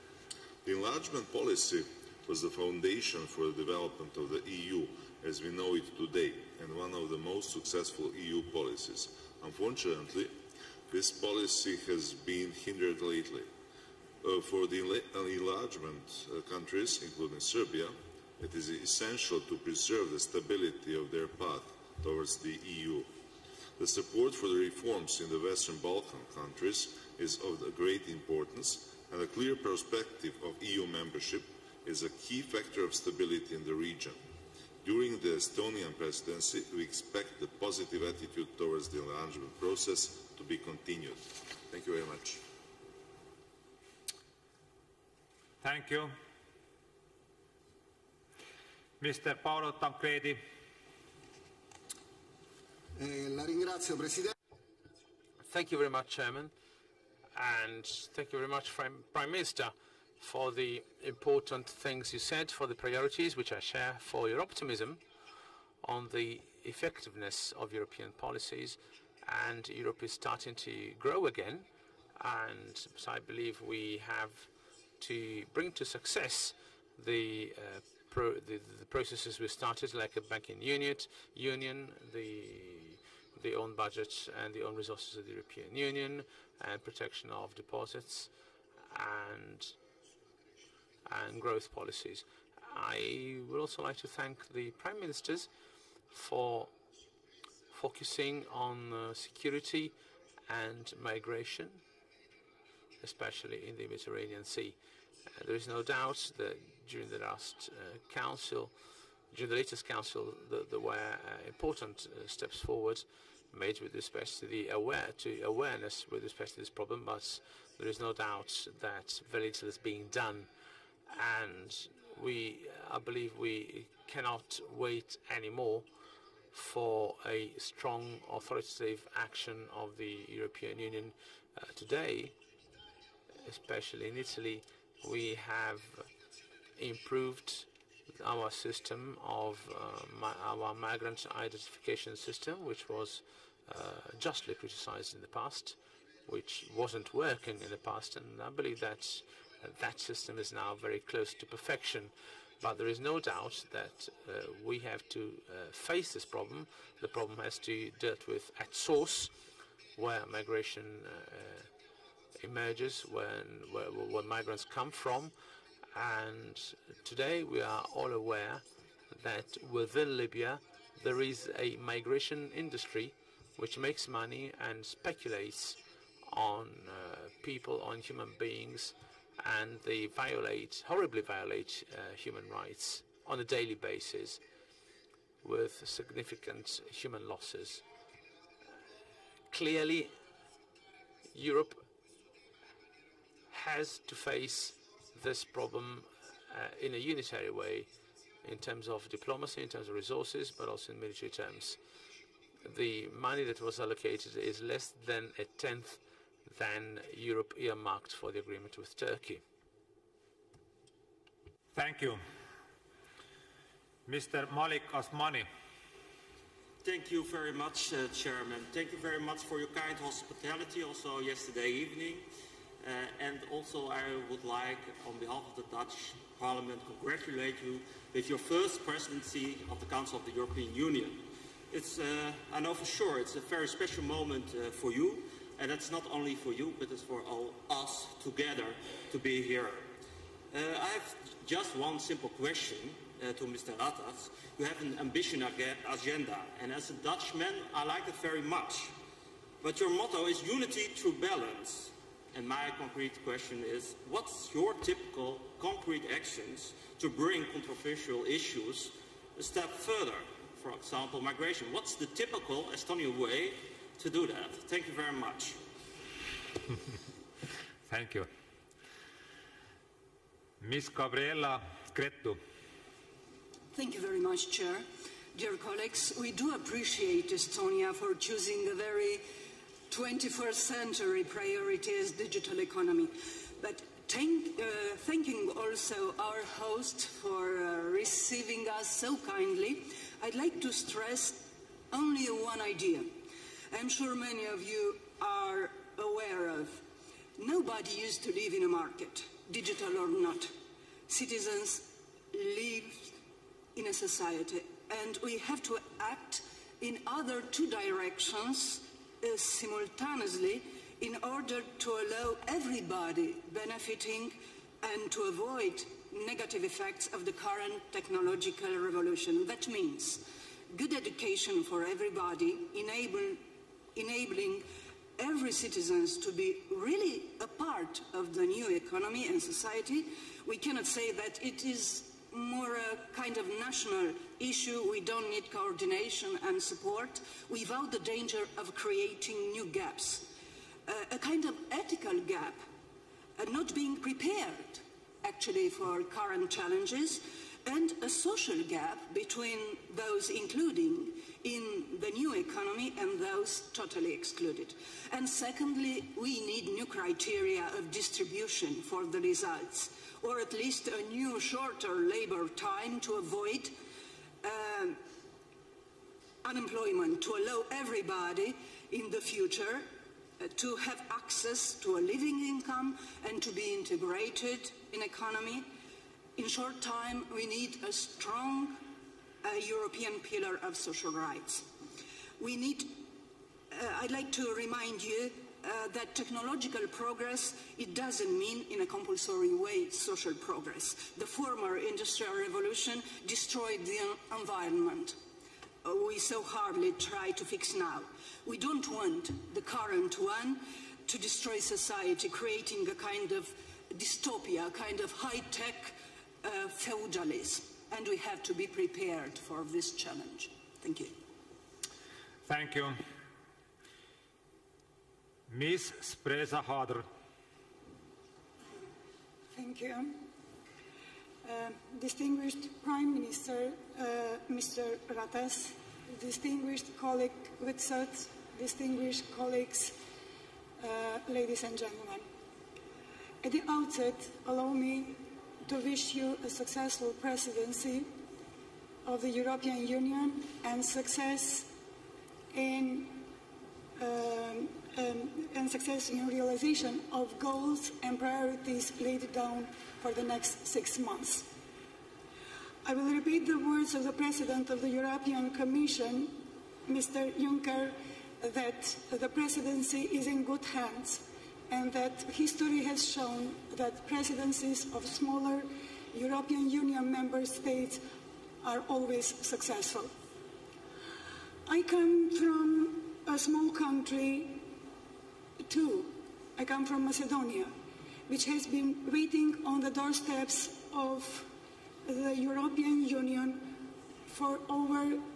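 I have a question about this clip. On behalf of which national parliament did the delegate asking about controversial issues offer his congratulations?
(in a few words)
Dutch Parliament.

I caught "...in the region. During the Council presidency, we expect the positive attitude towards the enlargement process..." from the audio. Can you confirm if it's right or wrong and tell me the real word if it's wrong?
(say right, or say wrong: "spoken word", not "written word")
wrong: "Estonian", not "Council".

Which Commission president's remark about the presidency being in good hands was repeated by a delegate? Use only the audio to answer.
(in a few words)
Juncker.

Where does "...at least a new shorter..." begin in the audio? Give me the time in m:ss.
6:00.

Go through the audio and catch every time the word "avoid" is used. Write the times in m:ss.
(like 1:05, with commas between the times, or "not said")
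5:15, 6:03.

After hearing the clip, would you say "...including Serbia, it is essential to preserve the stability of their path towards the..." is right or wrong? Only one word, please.
right.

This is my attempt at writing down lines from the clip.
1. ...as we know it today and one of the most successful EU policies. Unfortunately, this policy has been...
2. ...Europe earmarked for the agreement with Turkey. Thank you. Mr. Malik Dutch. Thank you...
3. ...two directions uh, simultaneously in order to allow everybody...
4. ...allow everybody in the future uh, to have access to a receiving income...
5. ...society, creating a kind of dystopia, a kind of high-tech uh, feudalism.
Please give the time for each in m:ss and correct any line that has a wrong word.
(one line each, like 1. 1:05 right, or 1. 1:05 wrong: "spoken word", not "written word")
1. 0:05 right
2. 3:27 wrong: "Azmani", not "Dutch"
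3. 5:07 right
4. 6:07 wrong: "living", not "receiving"
5. 6:41 right.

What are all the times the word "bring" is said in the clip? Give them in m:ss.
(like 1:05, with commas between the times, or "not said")
1:15, 4:17.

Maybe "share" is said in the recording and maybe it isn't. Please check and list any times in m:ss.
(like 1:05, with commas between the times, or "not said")
1:03.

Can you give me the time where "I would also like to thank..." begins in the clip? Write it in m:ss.
1:32.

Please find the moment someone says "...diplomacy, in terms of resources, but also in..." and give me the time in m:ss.
3:19.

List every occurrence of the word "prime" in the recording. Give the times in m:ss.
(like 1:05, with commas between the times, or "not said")
0:58, 1:34, 7:02.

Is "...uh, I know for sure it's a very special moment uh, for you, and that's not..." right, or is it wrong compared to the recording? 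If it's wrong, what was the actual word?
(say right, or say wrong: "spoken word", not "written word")
right.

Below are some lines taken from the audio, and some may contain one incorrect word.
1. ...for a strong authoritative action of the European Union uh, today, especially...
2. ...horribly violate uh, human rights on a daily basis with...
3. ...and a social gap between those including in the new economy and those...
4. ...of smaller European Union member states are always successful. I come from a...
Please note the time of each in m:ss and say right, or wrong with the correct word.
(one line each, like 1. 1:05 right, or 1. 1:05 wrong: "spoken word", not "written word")
1. 2:06 right
2. 3:00 right
3. 5:47 right
4. 7:44 right.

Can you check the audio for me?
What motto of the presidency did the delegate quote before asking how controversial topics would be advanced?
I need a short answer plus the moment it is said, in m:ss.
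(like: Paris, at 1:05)
unity through balance, at 4:10.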